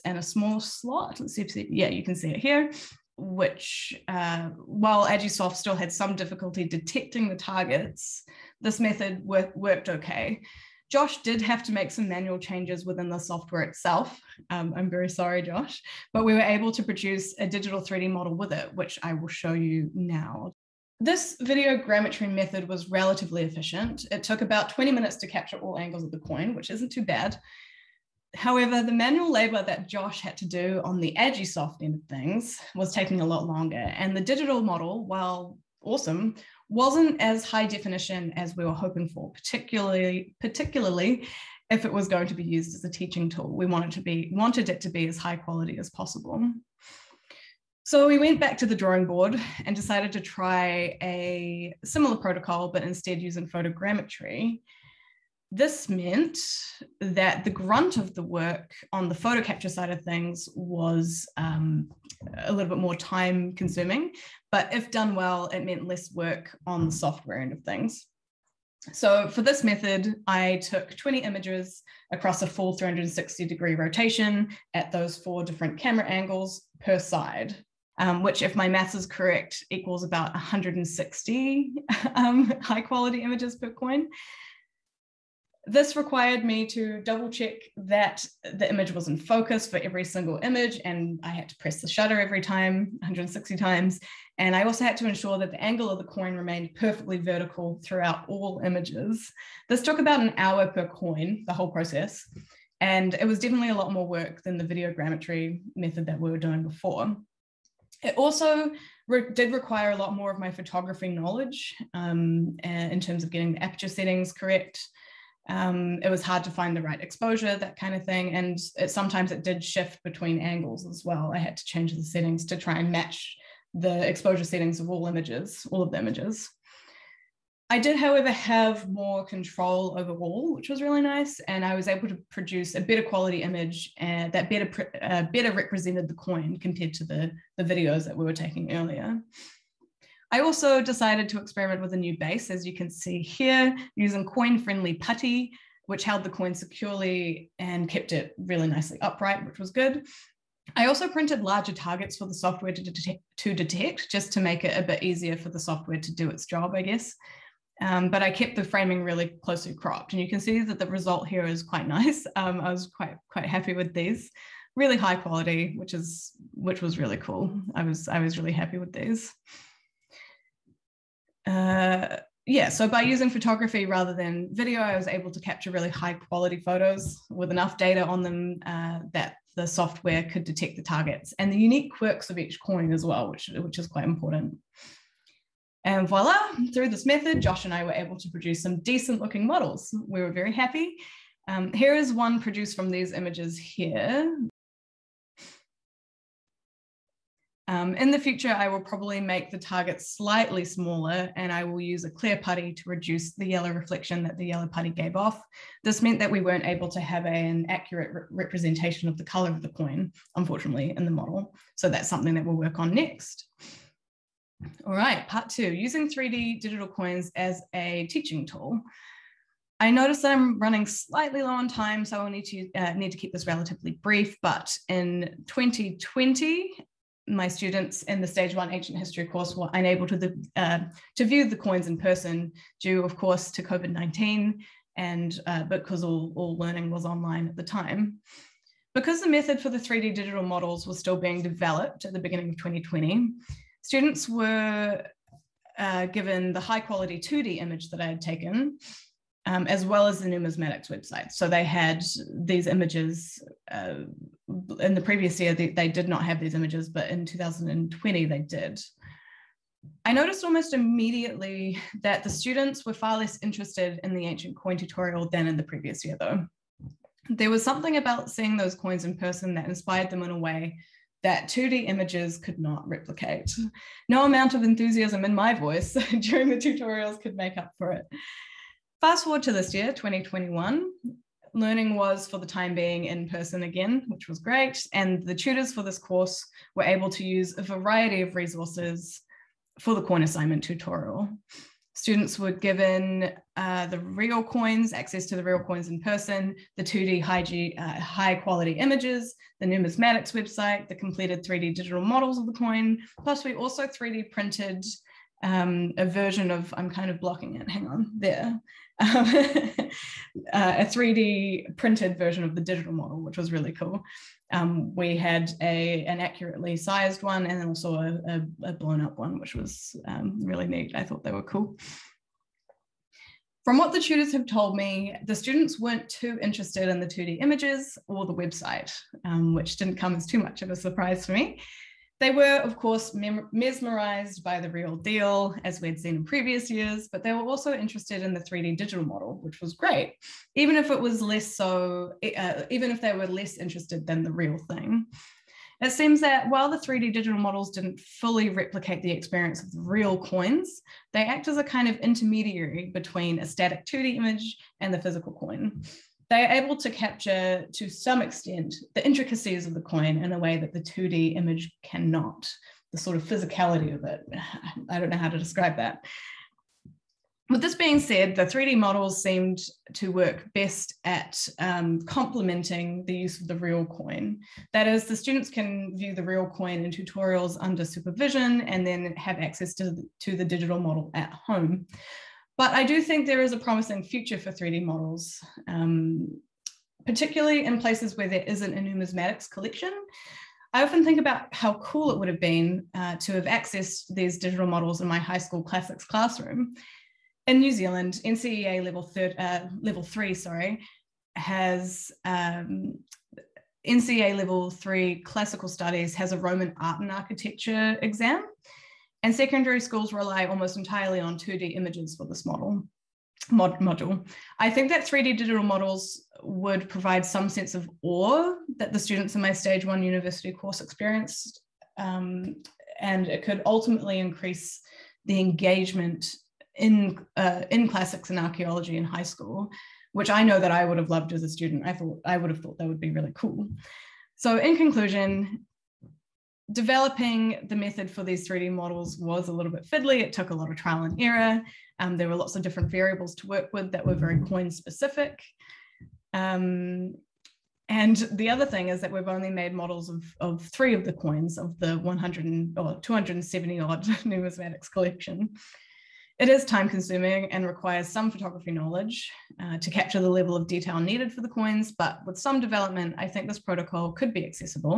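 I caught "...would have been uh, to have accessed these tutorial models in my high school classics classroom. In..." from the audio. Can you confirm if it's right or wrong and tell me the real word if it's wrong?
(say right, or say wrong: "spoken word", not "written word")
wrong: "digital", not "tutorial".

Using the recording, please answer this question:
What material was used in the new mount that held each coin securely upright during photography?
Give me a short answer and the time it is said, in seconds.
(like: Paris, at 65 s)
Coin-friendly putty, at 144 s.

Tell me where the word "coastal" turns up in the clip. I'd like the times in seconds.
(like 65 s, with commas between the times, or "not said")
not said.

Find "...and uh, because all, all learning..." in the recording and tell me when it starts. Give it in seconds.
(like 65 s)
234 s.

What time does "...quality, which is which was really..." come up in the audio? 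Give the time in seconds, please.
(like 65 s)
165 s.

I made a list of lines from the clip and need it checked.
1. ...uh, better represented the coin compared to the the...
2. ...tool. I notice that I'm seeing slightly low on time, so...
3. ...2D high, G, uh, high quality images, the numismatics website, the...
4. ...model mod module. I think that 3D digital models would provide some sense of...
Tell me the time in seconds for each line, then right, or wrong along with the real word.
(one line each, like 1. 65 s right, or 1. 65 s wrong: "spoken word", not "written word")
1. 135 s right
2. 218 s wrong: "running", not "seeing"
3. 296 s right
4. 412 s right.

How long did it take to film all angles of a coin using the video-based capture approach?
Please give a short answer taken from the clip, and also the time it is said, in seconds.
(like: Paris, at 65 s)
20 minutes, at 24 s.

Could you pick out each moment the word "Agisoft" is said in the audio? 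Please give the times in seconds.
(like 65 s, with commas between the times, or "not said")
5 s, 31 s.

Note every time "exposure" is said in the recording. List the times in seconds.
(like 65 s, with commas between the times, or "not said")
117 s, 124 s.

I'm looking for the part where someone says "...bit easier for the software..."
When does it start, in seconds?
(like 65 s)
154 s.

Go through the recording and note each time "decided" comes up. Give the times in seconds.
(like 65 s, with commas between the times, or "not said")
49 s, 140 s.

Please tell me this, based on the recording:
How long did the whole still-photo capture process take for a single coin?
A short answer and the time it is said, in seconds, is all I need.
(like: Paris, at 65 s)
An hour, at 100 s.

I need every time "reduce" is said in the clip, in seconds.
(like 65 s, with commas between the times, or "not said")
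202 s.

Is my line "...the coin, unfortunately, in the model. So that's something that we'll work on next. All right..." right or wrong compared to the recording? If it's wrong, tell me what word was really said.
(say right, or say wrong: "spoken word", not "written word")
right.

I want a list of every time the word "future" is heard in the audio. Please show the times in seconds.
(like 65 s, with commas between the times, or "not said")
198 s, 384 s.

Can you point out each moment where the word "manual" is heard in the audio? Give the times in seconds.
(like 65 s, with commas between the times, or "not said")
12 s, 28 s.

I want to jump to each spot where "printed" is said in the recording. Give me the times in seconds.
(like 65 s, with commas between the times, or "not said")
151 s, 304 s, 311 s.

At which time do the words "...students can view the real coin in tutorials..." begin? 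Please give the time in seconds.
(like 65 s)
375 s.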